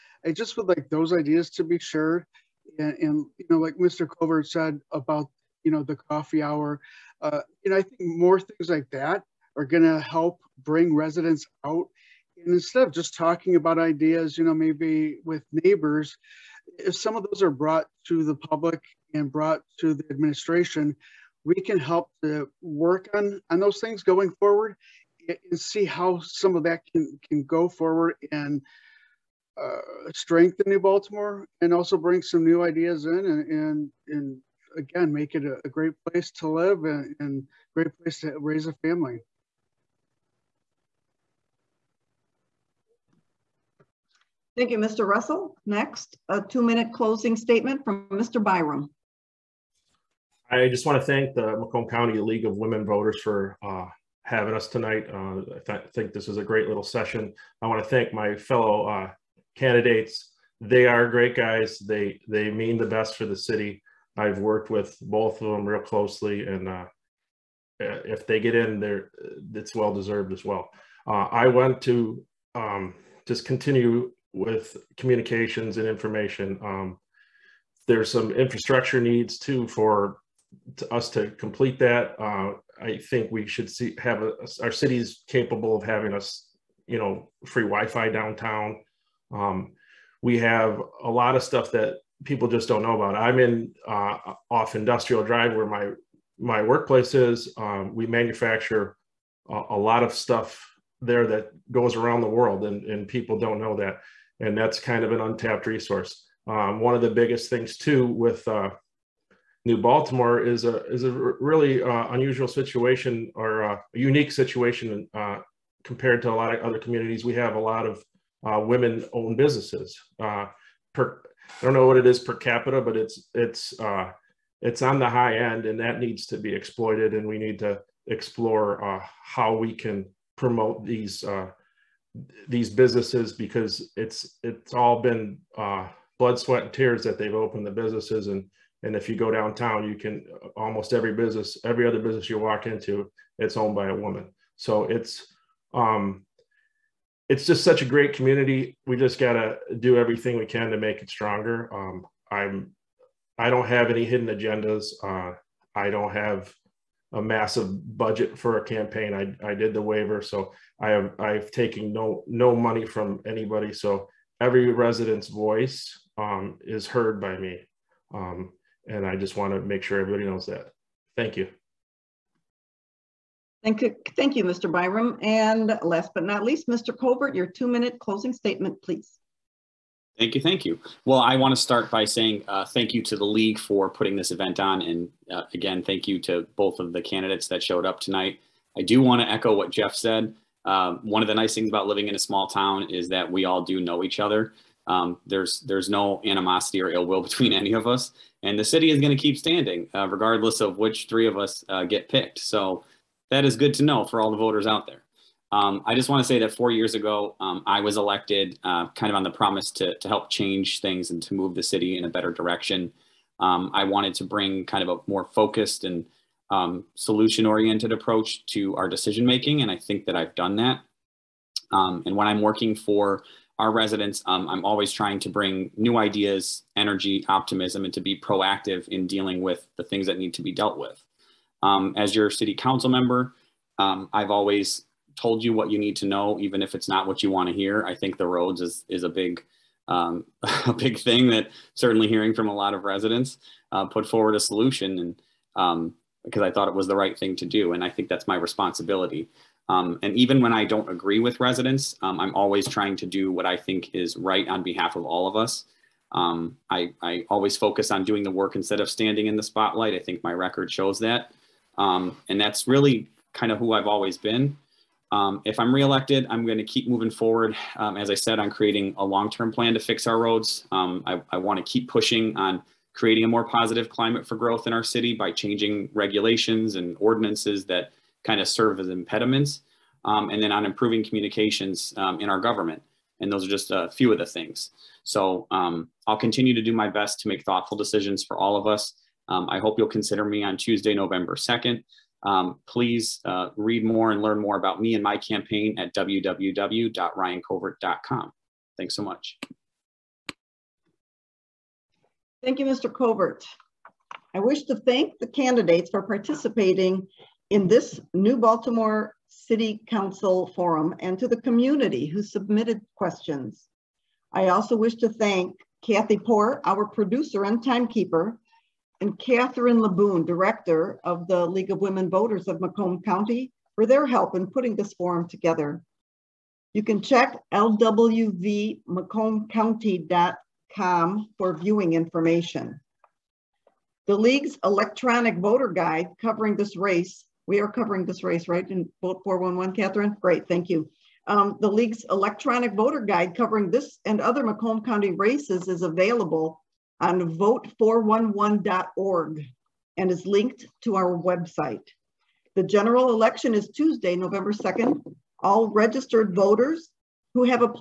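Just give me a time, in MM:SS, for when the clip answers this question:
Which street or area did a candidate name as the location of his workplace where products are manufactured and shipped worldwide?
01:34.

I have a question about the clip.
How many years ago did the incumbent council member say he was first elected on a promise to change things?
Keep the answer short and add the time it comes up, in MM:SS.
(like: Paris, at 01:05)
4, at 03:26.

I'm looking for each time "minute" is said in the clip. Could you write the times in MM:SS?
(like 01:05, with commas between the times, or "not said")
00:46, 02:57.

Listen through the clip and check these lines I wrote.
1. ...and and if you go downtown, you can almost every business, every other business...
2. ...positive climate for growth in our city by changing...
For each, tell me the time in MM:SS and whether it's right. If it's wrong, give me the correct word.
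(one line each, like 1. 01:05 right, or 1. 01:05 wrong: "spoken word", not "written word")
1. 02:18 right
2. 04:33 right.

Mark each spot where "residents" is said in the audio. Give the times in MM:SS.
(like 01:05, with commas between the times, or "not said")
00:10, 02:44, 03:43, 04:02, 04:11.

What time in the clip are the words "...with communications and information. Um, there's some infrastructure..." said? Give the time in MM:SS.
01:14.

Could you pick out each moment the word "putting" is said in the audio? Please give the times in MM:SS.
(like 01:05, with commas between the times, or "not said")
03:03, 05:24.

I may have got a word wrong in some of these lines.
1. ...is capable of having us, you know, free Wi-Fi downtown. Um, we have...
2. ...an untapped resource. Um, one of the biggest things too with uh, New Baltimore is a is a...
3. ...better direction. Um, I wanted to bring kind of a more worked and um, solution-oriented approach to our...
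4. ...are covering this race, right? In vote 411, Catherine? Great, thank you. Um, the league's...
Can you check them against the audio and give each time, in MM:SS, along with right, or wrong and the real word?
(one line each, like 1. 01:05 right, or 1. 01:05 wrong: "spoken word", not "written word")
1. 01:24 right
2. 01:45 right
3. 03:32 wrong: "focused", not "worked"
4. 05:37 right.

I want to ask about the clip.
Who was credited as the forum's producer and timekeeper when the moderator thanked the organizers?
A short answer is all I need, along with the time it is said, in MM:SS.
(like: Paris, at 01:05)
Kathy Poor, at 05:15.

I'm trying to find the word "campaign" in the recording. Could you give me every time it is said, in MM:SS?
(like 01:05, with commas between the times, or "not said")
02:38, 04:55.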